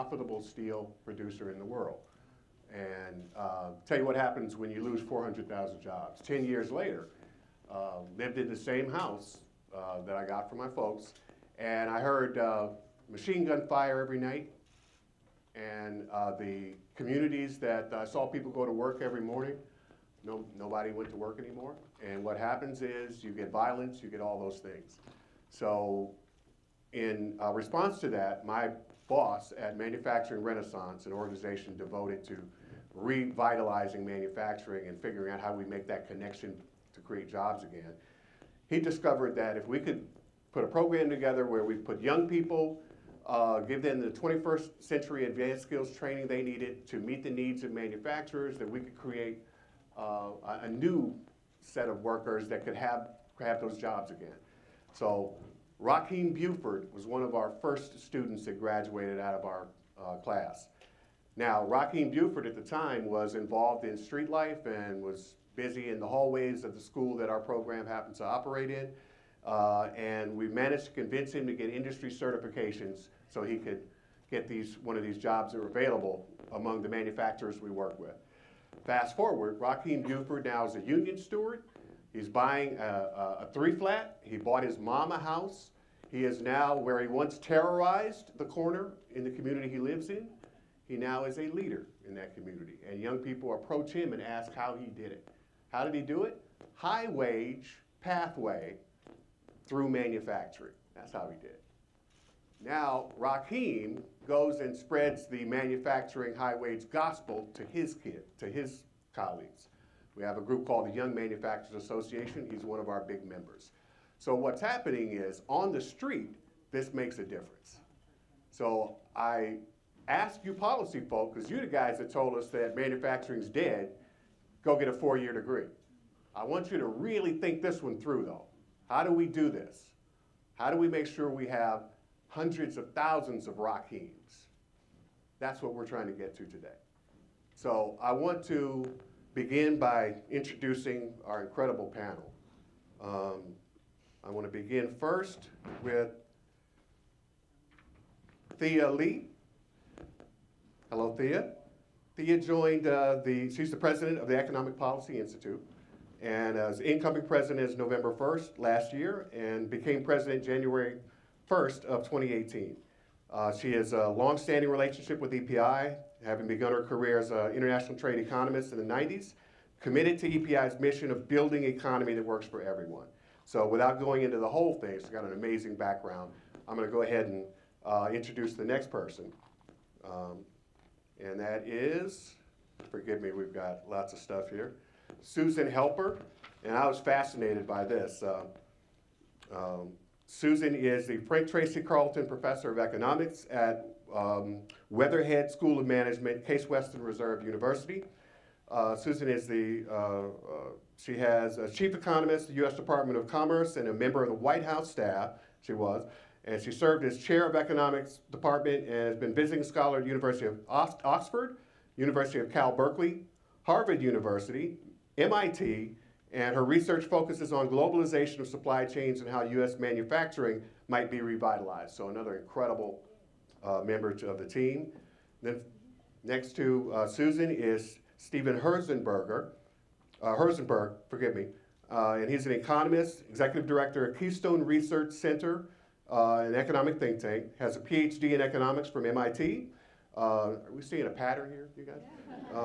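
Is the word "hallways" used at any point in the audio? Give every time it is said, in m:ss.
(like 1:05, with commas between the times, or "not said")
1:06.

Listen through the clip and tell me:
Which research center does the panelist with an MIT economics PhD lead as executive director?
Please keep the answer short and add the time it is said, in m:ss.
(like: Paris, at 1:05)
Keystone Research Center, at 3:54.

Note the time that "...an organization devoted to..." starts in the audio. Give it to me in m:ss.
0:31.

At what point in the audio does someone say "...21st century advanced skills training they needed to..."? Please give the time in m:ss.
0:44.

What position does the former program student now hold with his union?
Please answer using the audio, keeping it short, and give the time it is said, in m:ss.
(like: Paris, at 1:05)
Union steward, at 1:20.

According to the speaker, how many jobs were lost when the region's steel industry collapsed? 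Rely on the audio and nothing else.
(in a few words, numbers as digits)
400,000.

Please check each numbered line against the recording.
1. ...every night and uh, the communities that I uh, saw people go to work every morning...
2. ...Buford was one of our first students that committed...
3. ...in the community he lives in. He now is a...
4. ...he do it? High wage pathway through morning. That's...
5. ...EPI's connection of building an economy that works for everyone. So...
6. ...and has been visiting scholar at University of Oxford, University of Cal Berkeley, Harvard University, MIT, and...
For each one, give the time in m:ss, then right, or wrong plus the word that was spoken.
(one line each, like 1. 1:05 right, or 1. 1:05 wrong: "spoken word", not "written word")
1. 0:14 right
2. 0:56 wrong: "graduated", not "committed"
3. 1:29 right
4. 1:35 wrong: "manufacturing", not "morning"
5. 2:50 wrong: "mission", not "connection"
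6. 3:28 right.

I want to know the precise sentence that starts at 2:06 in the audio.
I want you to really think this one through though.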